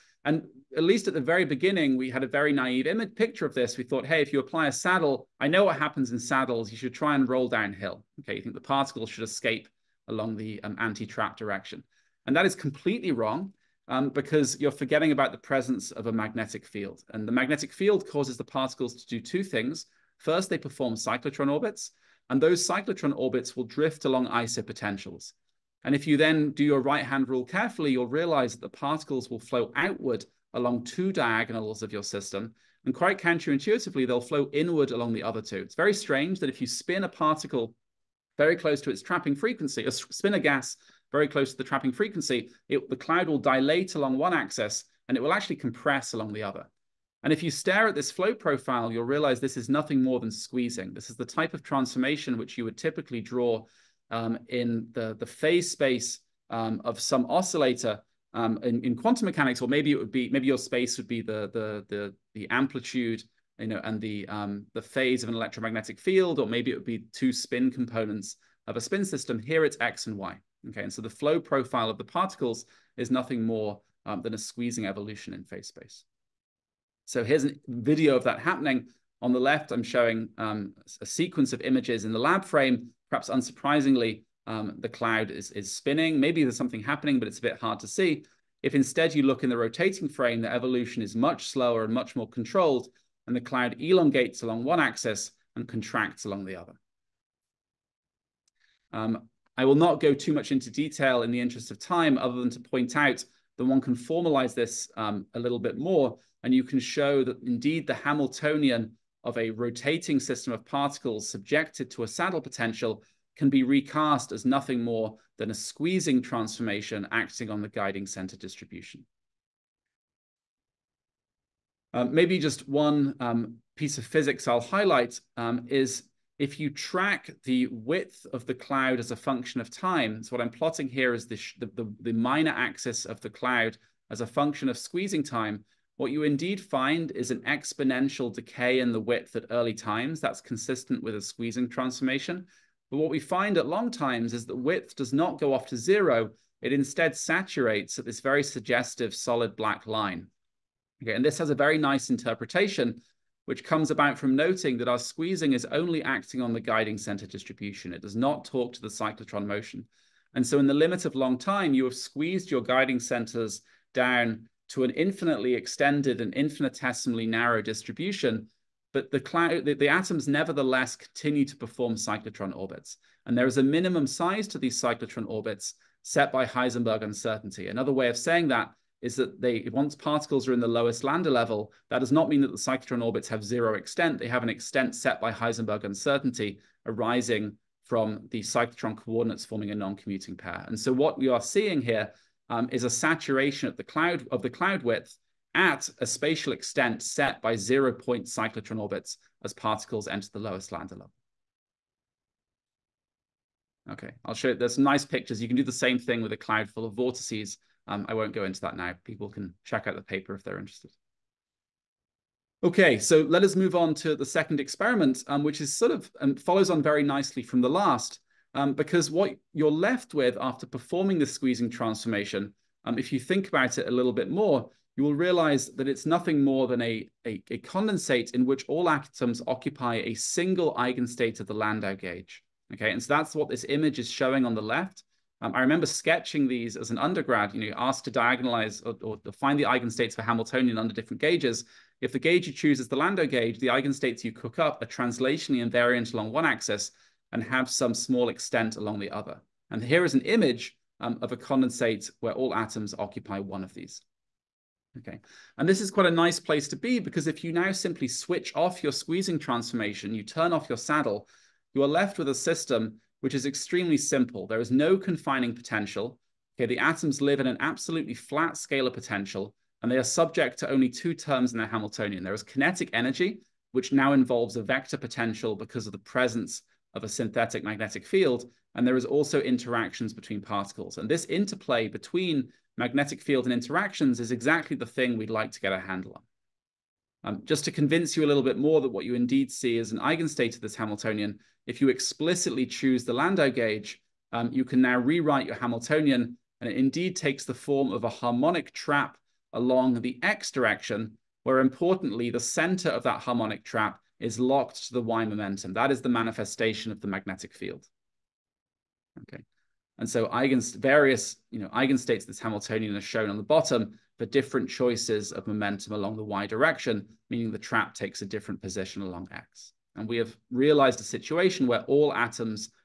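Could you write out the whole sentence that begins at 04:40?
And this interplay between magnetic field and interactions is exactly the thing we'd like to get a handle on.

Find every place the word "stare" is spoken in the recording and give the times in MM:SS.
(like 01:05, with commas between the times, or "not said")
00:47.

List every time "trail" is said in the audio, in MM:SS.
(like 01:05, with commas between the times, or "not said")
not said.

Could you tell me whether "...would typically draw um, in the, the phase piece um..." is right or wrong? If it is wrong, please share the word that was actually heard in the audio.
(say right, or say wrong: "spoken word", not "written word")
wrong: "space", not "piece".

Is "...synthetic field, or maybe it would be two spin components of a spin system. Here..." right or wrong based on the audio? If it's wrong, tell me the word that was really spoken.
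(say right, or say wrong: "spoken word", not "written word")
wrong: "electromagnetic", not "synthetic".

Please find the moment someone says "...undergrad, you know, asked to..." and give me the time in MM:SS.
03:56.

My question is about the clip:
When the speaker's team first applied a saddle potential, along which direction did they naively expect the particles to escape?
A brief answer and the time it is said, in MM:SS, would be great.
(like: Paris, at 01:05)
Anti-trap direction, at 00:10.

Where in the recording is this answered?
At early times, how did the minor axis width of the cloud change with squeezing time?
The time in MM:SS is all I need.
02:17.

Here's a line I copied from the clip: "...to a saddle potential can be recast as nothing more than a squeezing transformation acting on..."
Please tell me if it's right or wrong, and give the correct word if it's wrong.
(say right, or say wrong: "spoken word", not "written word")
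right.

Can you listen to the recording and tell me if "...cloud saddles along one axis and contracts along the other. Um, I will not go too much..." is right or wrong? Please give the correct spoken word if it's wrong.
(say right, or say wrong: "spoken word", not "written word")
wrong: "elongates", not "saddles".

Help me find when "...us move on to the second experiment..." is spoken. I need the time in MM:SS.
03:33.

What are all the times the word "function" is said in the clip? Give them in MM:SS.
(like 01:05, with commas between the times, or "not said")
02:09, 02:14.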